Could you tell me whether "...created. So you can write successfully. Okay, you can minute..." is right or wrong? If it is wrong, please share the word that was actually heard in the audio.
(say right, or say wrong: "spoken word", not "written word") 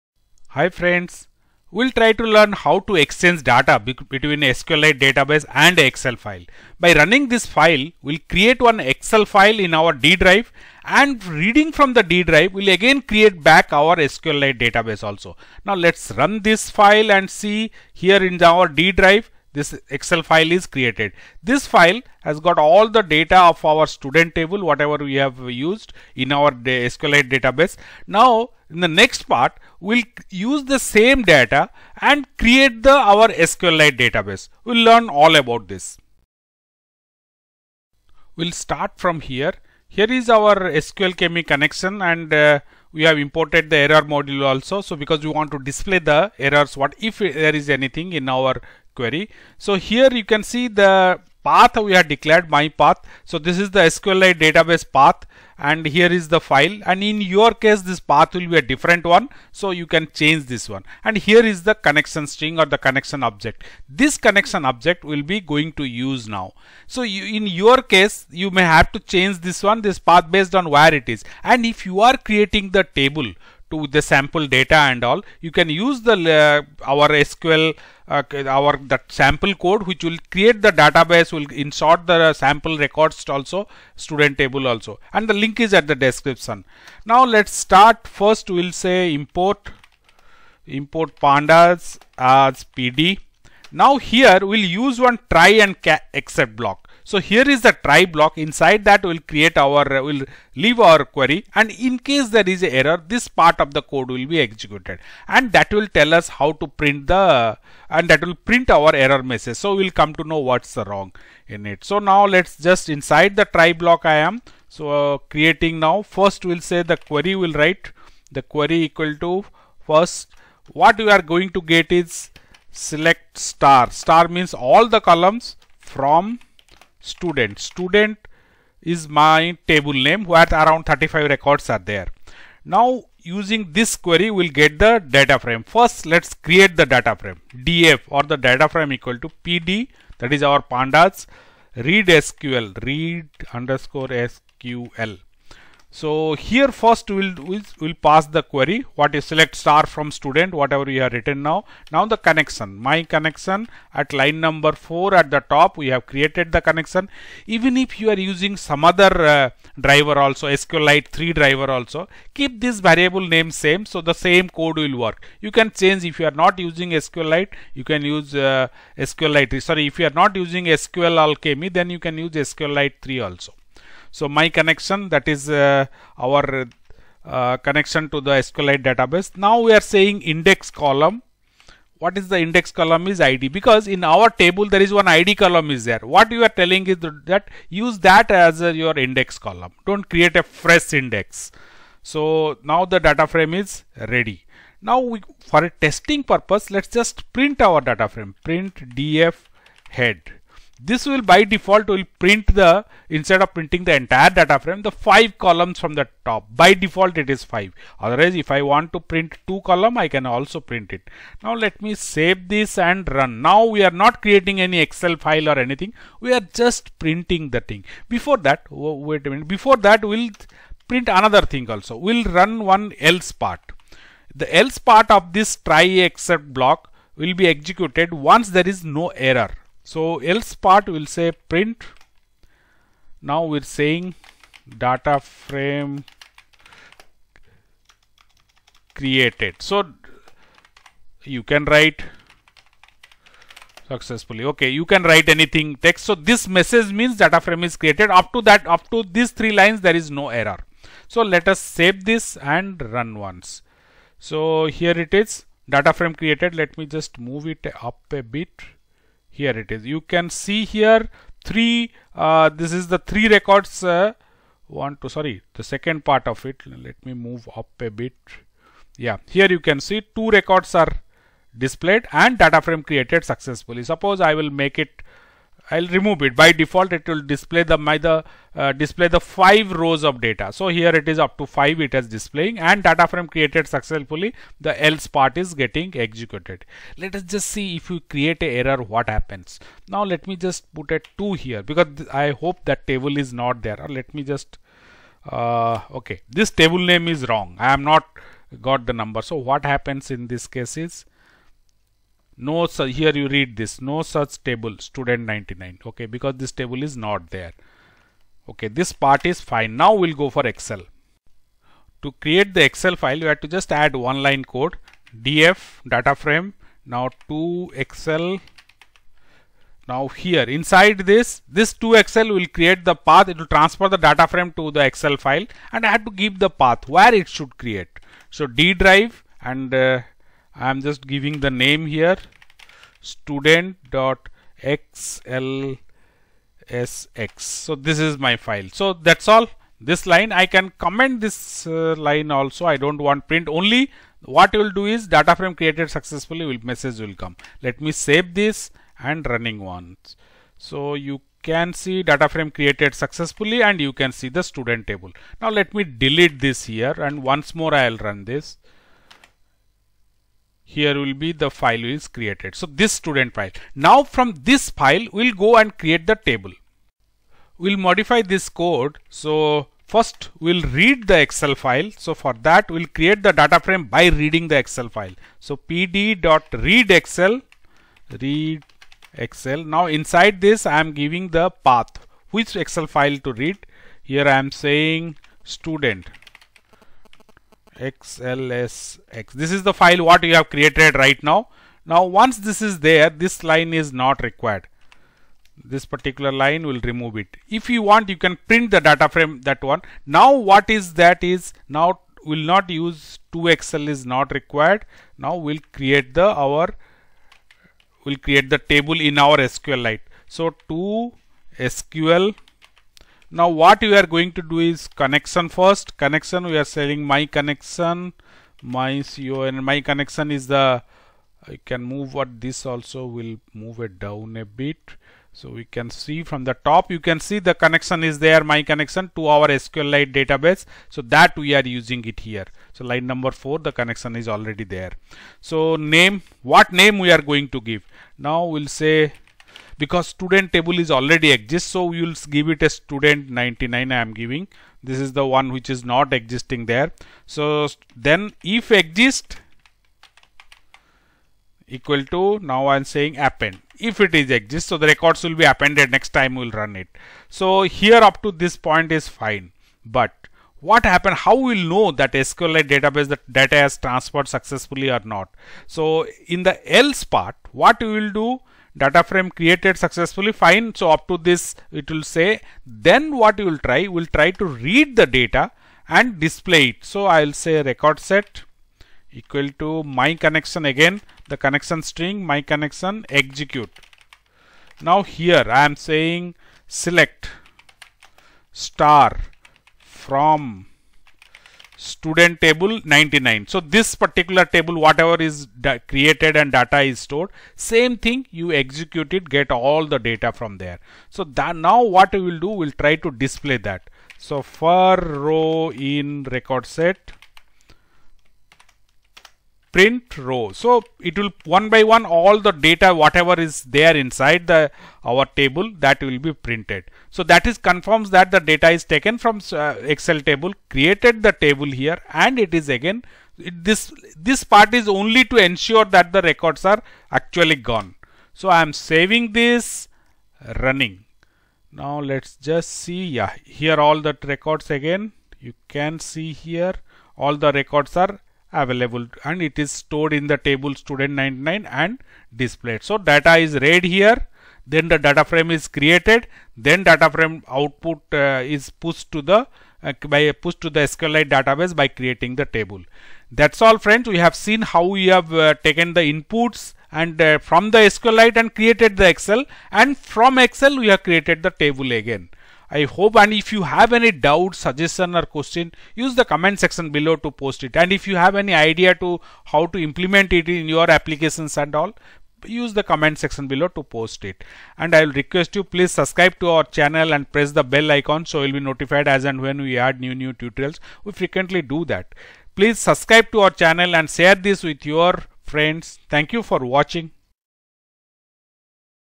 wrong: "write", not "minute".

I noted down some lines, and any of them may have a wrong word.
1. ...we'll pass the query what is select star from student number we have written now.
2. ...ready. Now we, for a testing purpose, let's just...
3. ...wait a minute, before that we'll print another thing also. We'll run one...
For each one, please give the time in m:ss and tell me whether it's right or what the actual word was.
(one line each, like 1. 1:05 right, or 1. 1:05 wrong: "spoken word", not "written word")
1. 2:27 wrong: "whatever", not "number"
2. 3:14 right
3. 3:38 right.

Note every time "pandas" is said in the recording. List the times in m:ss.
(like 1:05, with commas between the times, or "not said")
1:31, 2:20.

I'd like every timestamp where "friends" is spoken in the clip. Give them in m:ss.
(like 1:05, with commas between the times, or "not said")
0:00, 9:13, 9:45.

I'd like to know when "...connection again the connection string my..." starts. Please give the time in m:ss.
8:00.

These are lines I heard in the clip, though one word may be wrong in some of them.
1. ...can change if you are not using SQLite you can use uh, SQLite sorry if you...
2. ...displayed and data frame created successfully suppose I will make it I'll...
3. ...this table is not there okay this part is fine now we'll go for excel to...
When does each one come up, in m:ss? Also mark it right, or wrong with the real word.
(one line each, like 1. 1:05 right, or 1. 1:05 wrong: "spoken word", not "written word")
1. 2:45 right
2. 4:31 right
3. 5:06 right.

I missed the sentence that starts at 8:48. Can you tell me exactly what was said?
So I am saving this running.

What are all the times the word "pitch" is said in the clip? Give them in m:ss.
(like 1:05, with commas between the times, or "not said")
not said.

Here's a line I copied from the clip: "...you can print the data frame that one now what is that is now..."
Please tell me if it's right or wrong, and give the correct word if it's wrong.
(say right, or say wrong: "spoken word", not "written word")
right.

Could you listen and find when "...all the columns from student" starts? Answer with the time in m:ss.
2:04.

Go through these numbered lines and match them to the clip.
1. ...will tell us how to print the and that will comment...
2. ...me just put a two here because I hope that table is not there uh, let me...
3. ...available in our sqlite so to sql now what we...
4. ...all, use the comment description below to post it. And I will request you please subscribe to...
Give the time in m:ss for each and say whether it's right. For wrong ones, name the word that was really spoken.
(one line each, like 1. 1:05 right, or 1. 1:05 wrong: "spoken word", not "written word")
1. 1:45 wrong: "print", not "comment"
2. 4:50 right
3. 6:48 wrong: "table", not "available"
4. 9:31 wrong: "section", not "description".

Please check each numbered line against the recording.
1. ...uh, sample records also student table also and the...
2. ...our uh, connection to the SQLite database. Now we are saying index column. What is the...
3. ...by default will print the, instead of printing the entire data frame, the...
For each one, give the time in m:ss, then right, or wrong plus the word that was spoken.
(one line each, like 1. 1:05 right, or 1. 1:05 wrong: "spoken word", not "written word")
1. 1:22 right
2. 2:56 right
3. 3:21 right.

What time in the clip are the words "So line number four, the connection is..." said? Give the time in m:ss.
7:12.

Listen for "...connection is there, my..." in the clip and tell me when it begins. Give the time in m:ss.
7:07.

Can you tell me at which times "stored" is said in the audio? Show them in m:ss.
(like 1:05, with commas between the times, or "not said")
8:17, 8:59.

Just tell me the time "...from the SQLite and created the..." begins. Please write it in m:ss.
9:17.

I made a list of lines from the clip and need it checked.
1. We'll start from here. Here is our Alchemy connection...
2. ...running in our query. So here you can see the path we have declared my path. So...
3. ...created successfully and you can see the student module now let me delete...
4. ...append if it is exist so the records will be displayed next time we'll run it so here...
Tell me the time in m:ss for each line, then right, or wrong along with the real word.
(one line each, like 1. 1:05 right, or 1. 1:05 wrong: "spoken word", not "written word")
1. 0:38 wrong: "SQLAlchemy", not "Alchemy"
2. 0:47 wrong: "anything", not "running"
3. 5:52 wrong: "table", not "module"
4. 7:33 wrong: "appended", not "displayed".